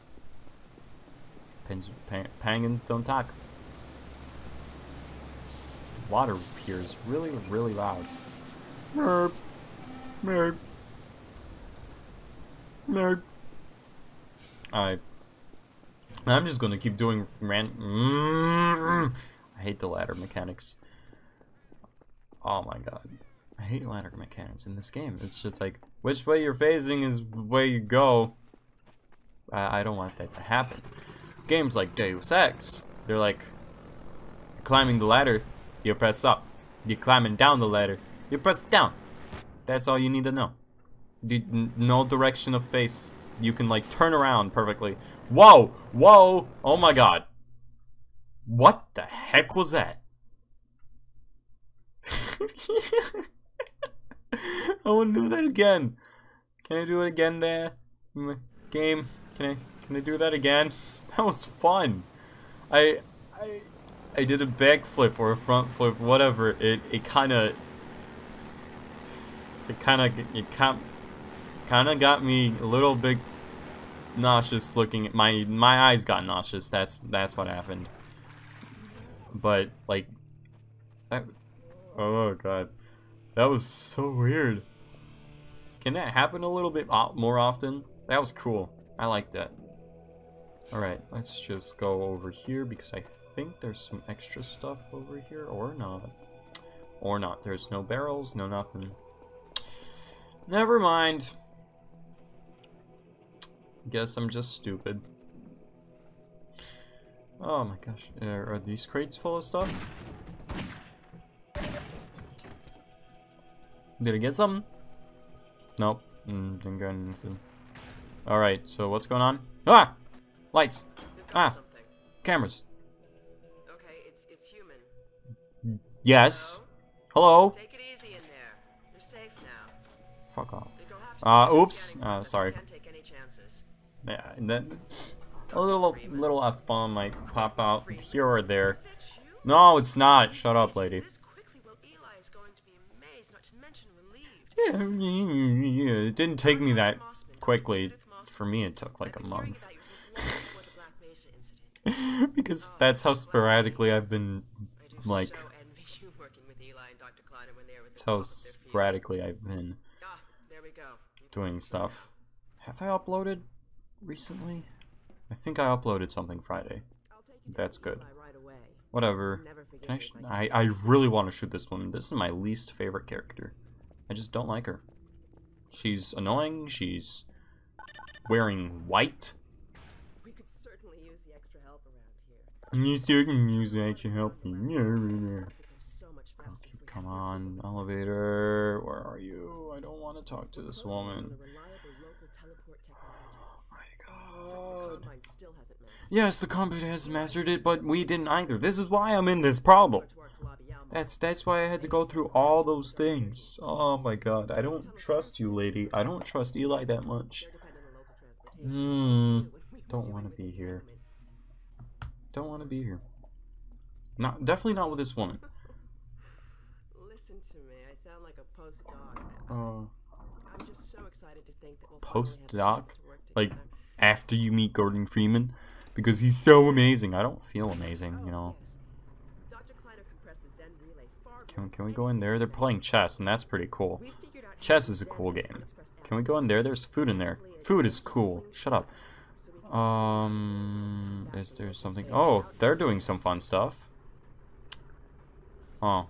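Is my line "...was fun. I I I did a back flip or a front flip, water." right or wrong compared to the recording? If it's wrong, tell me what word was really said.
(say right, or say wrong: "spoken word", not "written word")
wrong: "whatever", not "water".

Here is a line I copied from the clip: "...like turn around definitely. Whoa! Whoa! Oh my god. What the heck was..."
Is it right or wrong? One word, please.
wrong.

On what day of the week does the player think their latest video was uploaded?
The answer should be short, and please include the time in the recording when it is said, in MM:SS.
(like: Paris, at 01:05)
Friday, at 02:46.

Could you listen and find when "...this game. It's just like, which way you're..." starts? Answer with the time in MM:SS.
00:24.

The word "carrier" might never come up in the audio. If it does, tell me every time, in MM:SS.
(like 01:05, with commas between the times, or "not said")
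not said.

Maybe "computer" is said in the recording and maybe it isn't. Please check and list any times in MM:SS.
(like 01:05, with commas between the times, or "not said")
03:16.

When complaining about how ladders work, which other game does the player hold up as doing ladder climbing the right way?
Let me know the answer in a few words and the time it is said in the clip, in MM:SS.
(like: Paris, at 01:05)
Deus Ex, at 00:31.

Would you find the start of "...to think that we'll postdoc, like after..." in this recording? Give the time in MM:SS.
03:41.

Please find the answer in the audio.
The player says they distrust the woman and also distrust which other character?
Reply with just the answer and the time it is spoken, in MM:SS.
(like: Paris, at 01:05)
Eli, at 03:26.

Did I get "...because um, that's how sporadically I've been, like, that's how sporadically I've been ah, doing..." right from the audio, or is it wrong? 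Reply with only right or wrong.
right.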